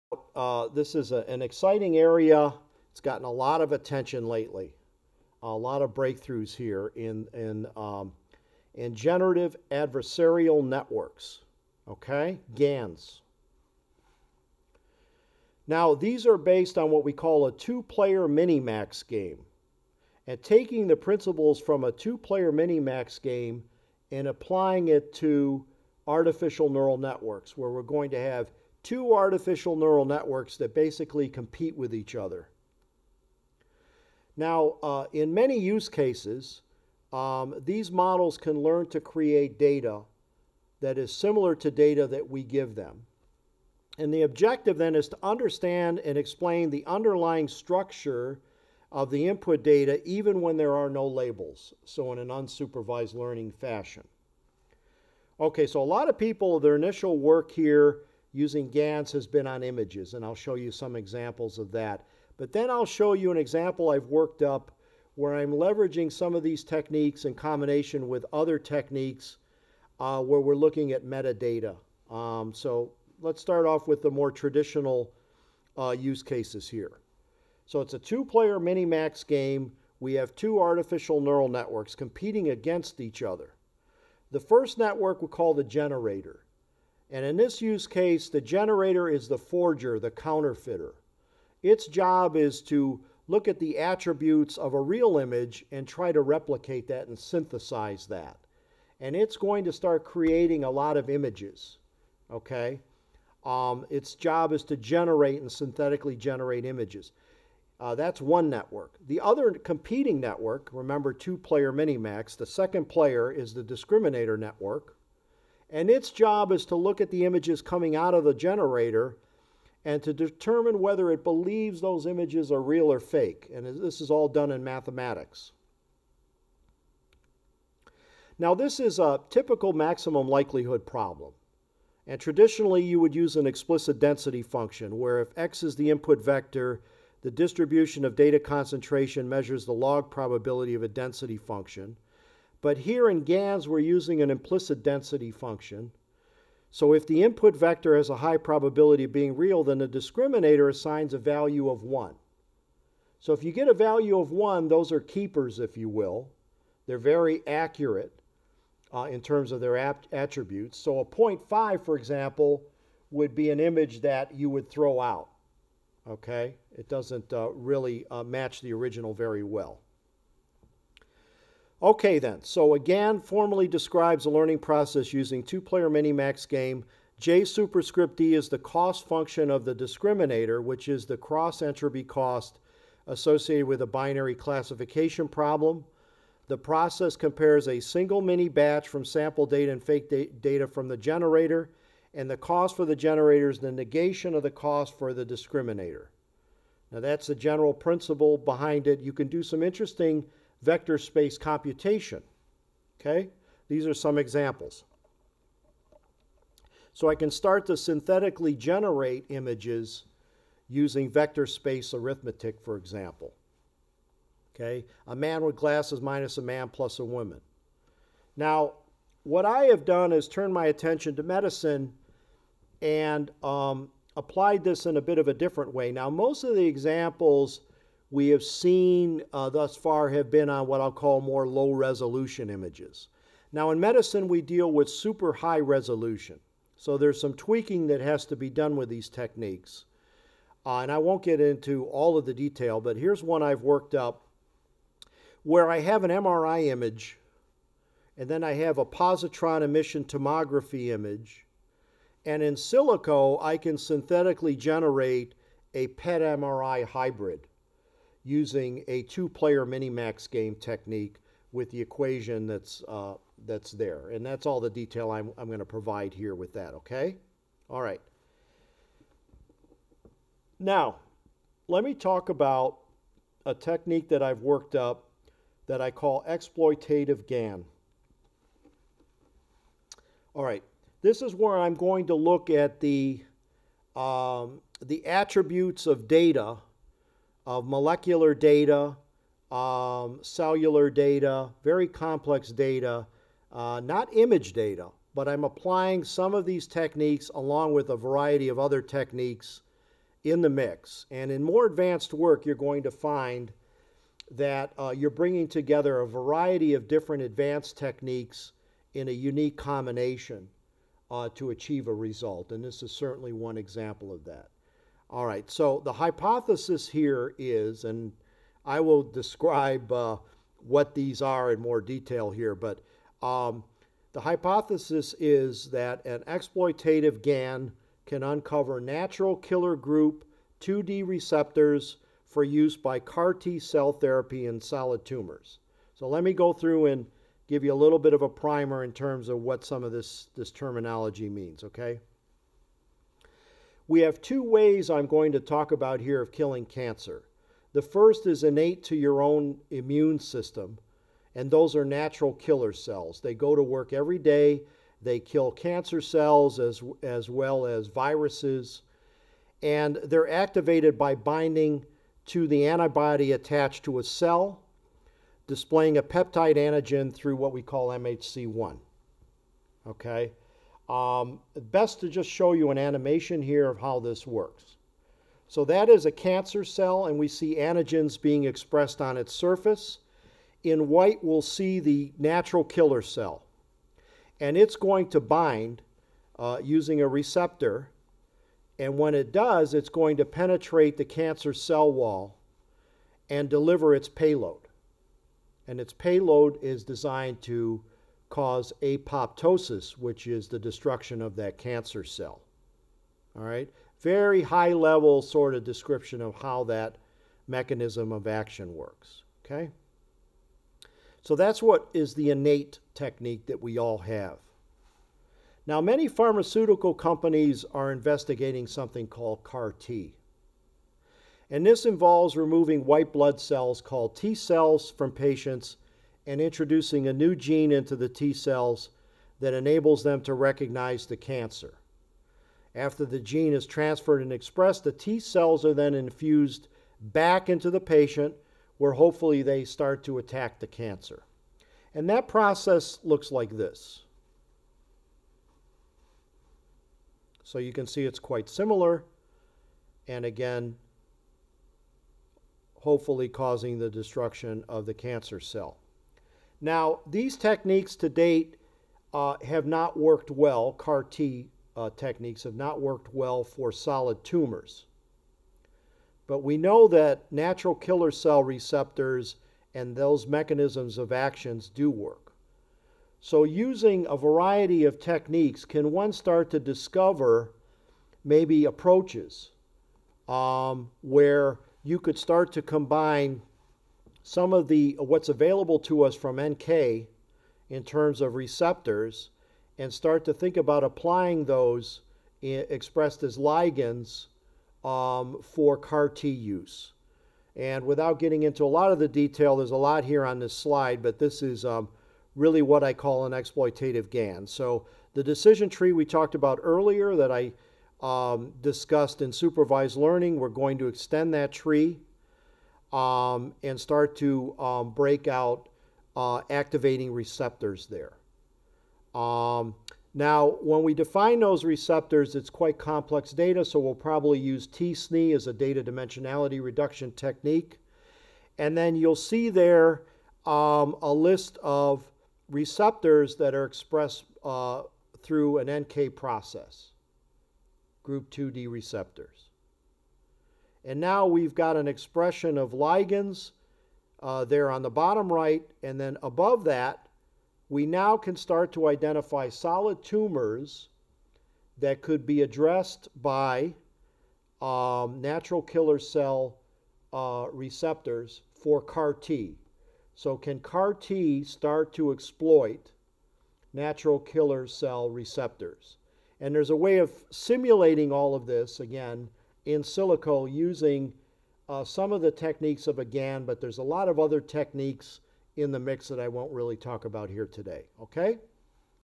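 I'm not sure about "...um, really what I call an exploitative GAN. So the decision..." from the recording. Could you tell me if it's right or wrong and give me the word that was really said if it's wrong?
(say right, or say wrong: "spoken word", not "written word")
right.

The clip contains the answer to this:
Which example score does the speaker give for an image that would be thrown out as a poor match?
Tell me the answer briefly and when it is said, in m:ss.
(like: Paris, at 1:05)
0.5, at 2:41.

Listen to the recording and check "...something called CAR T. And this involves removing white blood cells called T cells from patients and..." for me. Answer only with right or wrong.
right.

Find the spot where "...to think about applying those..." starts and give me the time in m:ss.
8:10.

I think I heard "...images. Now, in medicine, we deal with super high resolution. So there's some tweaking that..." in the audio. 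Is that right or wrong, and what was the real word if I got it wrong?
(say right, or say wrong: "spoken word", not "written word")
right.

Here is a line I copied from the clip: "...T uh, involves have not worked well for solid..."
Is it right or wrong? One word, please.
wrong.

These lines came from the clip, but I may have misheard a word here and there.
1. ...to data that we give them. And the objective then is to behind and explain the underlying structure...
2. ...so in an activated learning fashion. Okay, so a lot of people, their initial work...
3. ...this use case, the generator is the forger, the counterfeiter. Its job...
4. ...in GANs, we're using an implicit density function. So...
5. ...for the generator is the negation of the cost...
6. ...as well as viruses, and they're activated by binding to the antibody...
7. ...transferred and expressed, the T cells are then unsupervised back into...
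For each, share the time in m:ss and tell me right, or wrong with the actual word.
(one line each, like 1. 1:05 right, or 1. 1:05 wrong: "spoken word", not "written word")
1. 0:41 wrong: "understand", not "behind"
2. 0:51 wrong: "unsupervised", not "activated"
3. 1:27 right
4. 2:23 right
5. 3:12 right
6. 5:57 right
7. 7:13 wrong: "infused", not "unsupervised".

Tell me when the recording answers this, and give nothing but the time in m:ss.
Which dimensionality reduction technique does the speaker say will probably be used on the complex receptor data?
8:44.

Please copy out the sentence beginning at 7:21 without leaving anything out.
And that process looks like this.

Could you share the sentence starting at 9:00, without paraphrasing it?
And now we've got an expression of ligands uh, there on the bottom right.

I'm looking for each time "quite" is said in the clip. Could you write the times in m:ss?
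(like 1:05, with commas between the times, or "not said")
7:28, 8:42.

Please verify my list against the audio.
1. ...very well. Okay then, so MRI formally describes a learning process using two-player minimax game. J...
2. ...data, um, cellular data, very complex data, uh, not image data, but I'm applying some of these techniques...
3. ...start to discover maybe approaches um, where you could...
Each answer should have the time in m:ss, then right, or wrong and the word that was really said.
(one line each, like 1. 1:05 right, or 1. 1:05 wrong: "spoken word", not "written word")
1. 2:49 wrong: "GAN", not "MRI"
2. 4:48 right
3. 7:56 right.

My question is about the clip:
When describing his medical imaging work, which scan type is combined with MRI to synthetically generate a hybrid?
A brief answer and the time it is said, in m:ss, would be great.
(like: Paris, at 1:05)
positron emission tomography, at 4:08.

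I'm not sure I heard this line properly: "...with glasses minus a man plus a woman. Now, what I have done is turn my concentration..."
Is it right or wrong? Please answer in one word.
wrong.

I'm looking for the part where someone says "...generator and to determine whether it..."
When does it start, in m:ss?
1:58.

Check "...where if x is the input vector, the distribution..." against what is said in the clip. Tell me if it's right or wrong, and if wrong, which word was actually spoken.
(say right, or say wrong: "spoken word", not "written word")
right.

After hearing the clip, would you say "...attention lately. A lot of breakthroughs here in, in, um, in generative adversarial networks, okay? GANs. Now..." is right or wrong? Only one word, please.
right.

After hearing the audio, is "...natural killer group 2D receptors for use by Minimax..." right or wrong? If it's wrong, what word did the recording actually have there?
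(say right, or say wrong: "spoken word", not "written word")
wrong: "CAR", not "Minimax".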